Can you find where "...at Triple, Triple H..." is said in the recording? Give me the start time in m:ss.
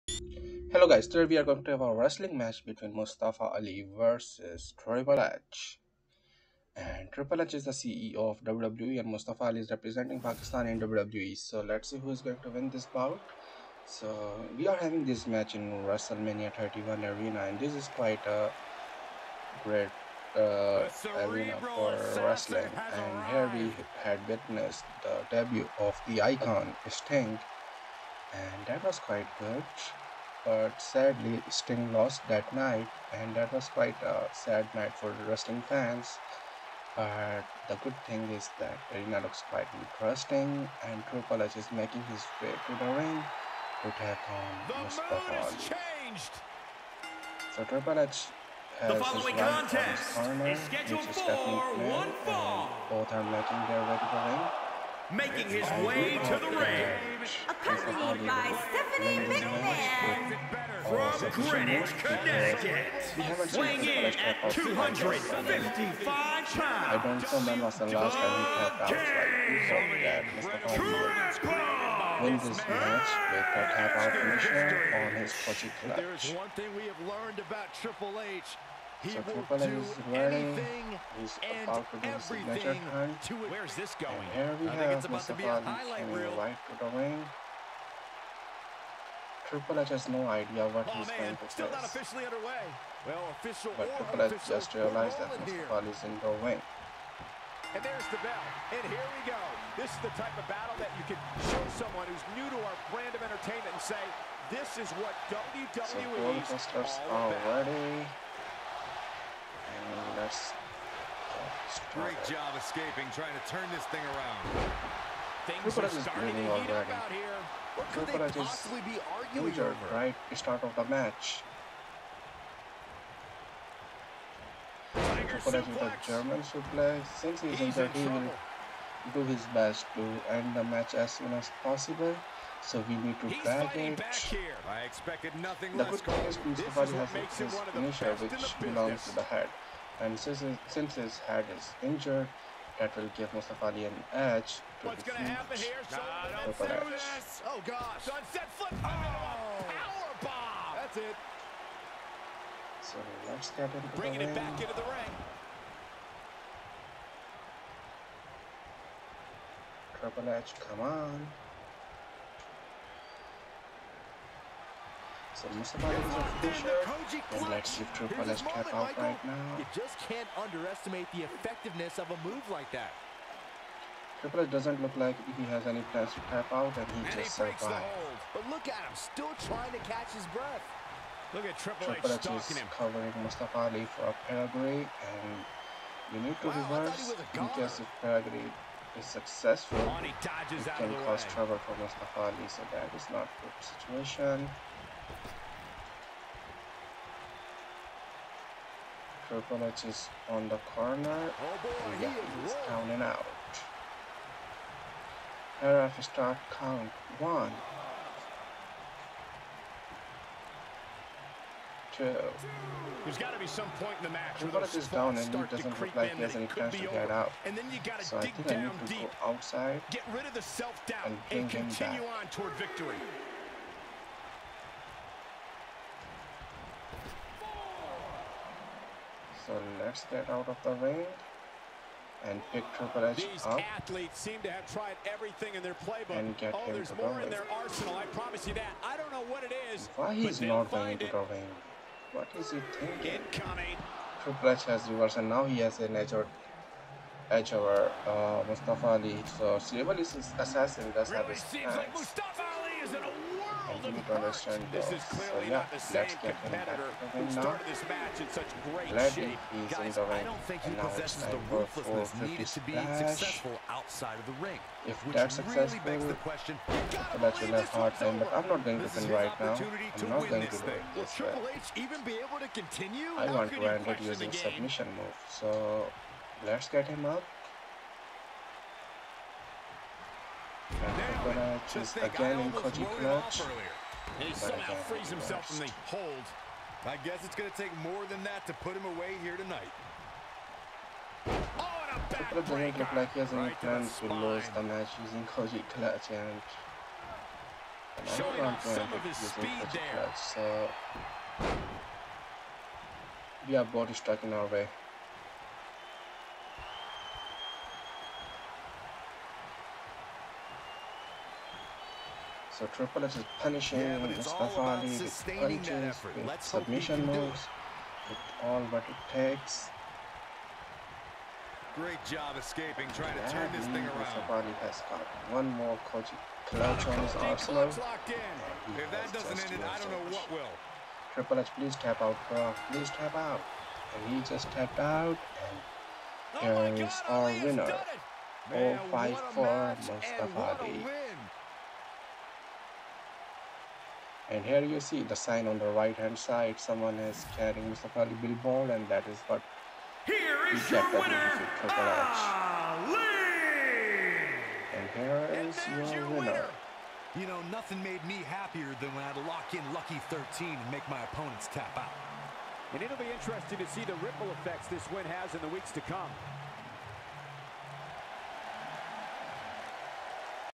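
3:01.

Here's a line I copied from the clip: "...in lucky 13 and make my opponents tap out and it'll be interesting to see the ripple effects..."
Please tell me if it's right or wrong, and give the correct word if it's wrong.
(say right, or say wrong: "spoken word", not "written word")
right.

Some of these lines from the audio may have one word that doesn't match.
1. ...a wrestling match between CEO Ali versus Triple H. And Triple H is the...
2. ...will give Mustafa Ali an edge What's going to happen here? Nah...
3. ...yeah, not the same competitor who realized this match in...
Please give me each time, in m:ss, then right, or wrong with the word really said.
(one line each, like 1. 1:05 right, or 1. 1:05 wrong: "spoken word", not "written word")
1. 0:01 wrong: "Mustafa", not "CEO"
2. 2:22 right
3. 4:15 wrong: "started", not "realized".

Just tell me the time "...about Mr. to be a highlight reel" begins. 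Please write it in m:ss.
1:25.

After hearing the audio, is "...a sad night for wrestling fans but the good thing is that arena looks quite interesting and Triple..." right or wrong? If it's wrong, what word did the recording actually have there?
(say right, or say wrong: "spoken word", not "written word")
right.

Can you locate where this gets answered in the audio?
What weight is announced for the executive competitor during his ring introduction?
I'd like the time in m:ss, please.
1:04.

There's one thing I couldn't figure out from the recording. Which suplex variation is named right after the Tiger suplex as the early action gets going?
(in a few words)
German suplex.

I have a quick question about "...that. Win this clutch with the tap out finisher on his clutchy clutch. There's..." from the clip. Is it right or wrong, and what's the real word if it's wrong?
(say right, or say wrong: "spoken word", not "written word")
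wrong: "match", not "clutch".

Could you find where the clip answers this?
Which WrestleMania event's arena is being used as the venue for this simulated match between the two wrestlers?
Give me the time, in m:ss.
0:15.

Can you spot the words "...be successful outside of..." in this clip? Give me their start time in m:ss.
4:22.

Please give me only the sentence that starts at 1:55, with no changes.
Things are starting to heat already.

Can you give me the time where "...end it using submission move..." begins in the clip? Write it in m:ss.
4:33.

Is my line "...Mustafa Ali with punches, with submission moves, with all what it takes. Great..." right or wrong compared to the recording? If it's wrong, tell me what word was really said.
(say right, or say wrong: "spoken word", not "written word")
right.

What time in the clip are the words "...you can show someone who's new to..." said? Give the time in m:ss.
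1:40.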